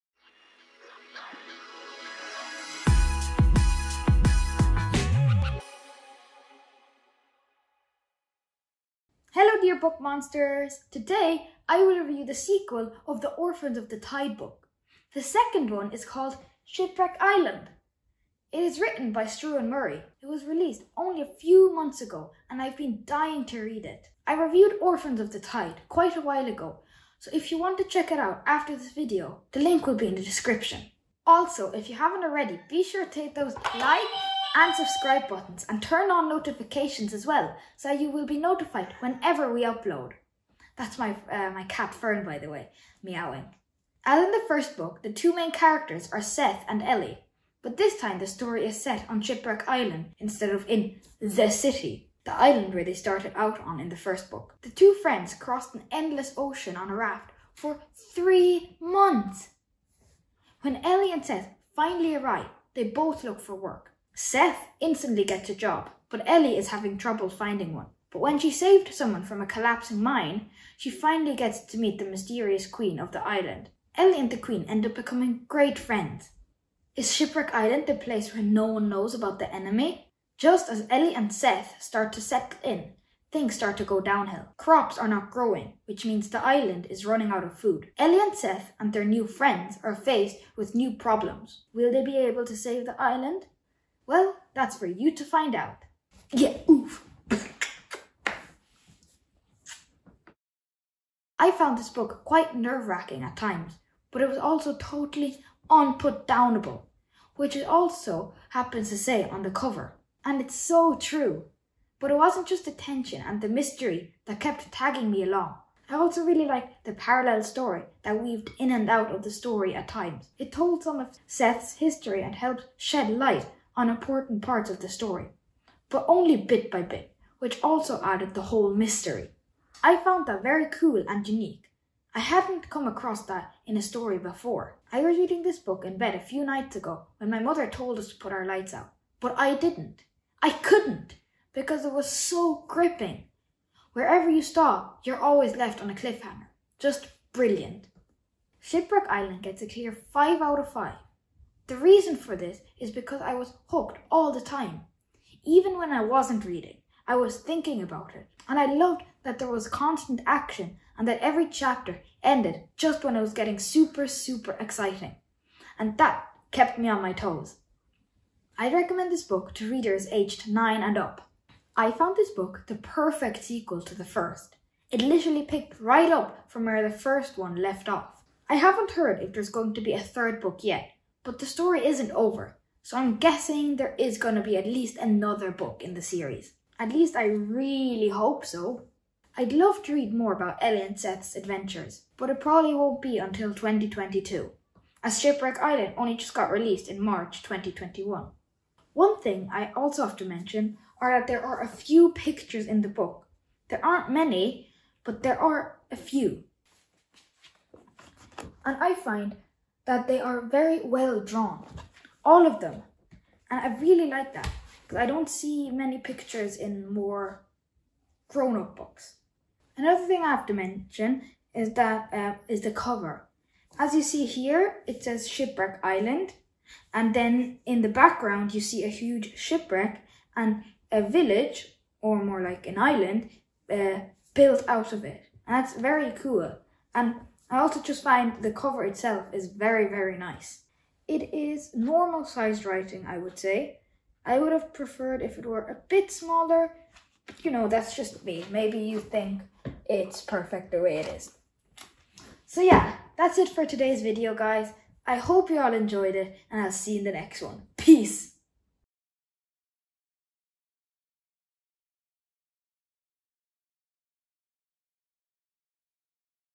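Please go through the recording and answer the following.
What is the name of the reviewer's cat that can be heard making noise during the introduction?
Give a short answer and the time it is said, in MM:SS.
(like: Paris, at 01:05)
Fern, at 00:41.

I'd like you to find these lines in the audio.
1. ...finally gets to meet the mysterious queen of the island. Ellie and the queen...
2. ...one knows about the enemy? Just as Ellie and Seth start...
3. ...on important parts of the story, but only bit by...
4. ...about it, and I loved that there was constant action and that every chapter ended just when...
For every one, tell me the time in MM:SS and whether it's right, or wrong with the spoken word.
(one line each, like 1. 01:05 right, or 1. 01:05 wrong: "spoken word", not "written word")
1. 01:10 right
2. 01:18 right
3. 02:03 right
4. 02:37 right.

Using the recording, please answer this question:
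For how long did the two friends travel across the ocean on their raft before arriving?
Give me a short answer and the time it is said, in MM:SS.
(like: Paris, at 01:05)
3 months, at 00:58.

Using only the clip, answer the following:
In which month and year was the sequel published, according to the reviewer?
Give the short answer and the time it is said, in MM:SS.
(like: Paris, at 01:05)
March 2021, at 03:16.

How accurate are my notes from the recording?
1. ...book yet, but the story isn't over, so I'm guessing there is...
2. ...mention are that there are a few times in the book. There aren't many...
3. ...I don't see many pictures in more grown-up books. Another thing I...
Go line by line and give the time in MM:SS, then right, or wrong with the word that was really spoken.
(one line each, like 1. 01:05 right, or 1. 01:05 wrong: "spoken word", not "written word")
1. 03:00 right
2. 03:20 wrong: "pictures", not "times"
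3. 03:35 right.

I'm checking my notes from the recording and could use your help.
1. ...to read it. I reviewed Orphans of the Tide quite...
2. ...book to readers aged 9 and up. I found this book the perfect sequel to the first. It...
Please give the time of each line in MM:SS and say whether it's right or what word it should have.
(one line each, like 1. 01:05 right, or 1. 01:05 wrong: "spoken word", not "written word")
1. 00:23 right
2. 02:49 right.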